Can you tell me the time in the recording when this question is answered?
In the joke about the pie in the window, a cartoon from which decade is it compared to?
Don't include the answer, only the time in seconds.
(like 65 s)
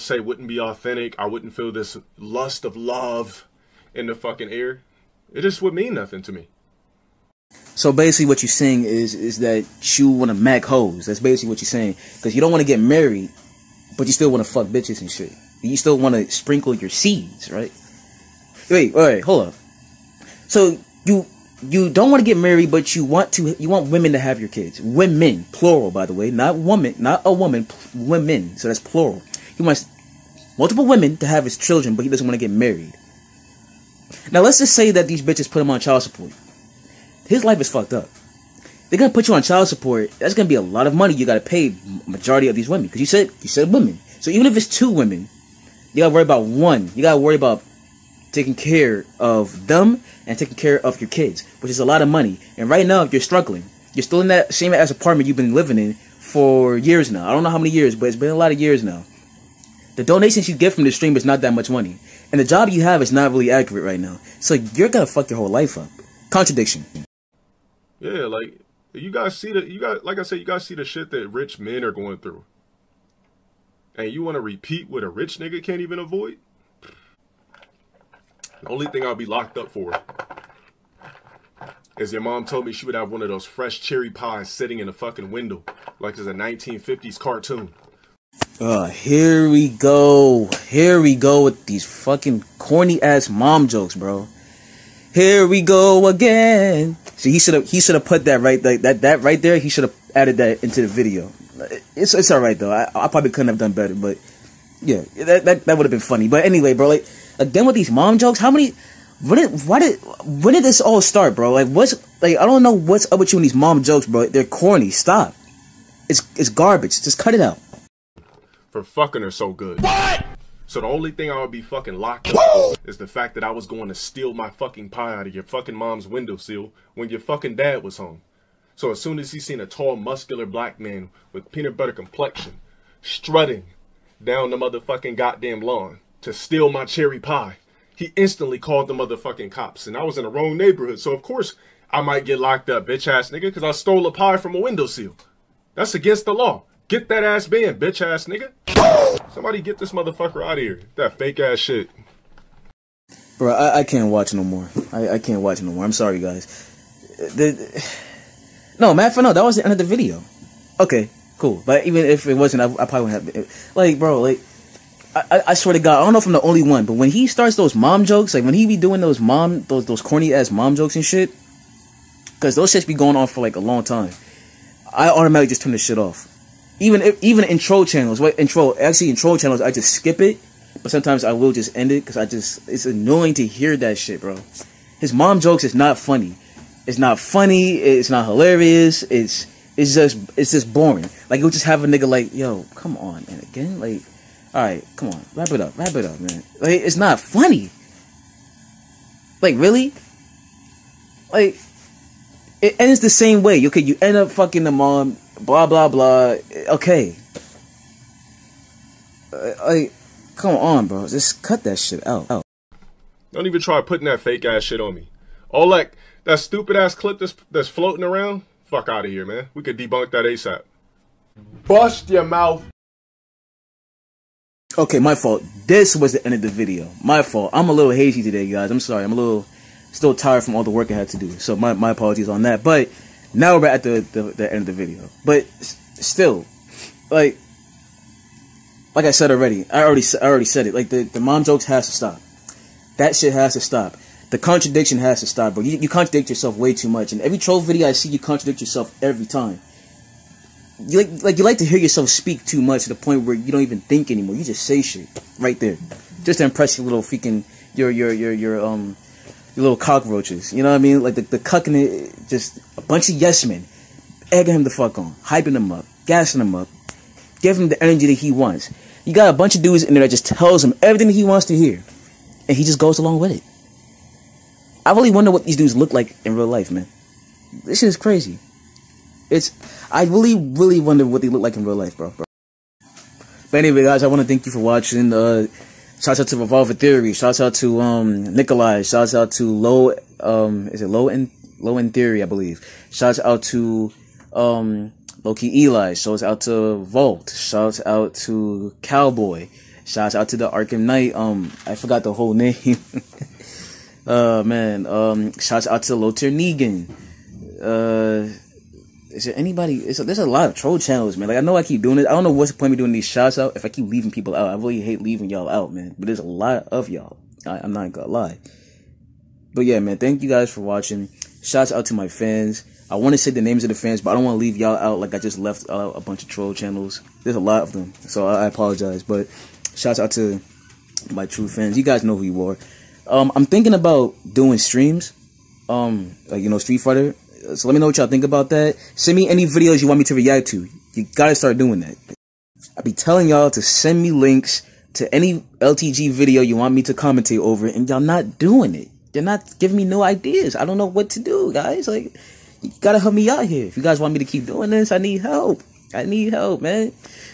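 86 s.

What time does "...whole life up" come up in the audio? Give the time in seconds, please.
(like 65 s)
65 s.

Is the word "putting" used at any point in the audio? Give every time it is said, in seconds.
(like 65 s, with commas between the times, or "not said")
213 s.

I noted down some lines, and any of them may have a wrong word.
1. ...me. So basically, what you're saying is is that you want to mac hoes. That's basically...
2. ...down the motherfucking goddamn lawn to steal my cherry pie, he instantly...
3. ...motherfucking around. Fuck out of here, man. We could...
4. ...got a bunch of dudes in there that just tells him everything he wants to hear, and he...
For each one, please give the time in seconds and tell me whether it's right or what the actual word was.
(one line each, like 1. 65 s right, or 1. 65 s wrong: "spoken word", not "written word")
1. 6 s right
2. 134 s right
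3. 217 s wrong: "floating", not "motherfucking"
4. 269 s right.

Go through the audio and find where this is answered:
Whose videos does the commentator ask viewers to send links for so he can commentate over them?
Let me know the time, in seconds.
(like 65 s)
345 s.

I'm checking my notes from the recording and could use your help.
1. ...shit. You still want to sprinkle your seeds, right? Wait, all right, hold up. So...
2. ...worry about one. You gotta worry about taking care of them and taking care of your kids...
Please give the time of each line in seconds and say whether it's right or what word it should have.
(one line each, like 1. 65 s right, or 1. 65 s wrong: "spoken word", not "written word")
1. 15 s right
2. 46 s right.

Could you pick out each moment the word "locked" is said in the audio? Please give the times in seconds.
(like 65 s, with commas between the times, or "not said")
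79 s, 121 s, 142 s.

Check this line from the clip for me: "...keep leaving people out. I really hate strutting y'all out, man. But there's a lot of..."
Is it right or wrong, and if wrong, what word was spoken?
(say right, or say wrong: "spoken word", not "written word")
wrong: "leaving", not "strutting".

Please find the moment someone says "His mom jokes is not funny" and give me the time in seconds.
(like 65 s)
184 s.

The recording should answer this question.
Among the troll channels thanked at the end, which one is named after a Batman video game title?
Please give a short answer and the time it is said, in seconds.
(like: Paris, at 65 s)
Arkham Knight, at 300 s.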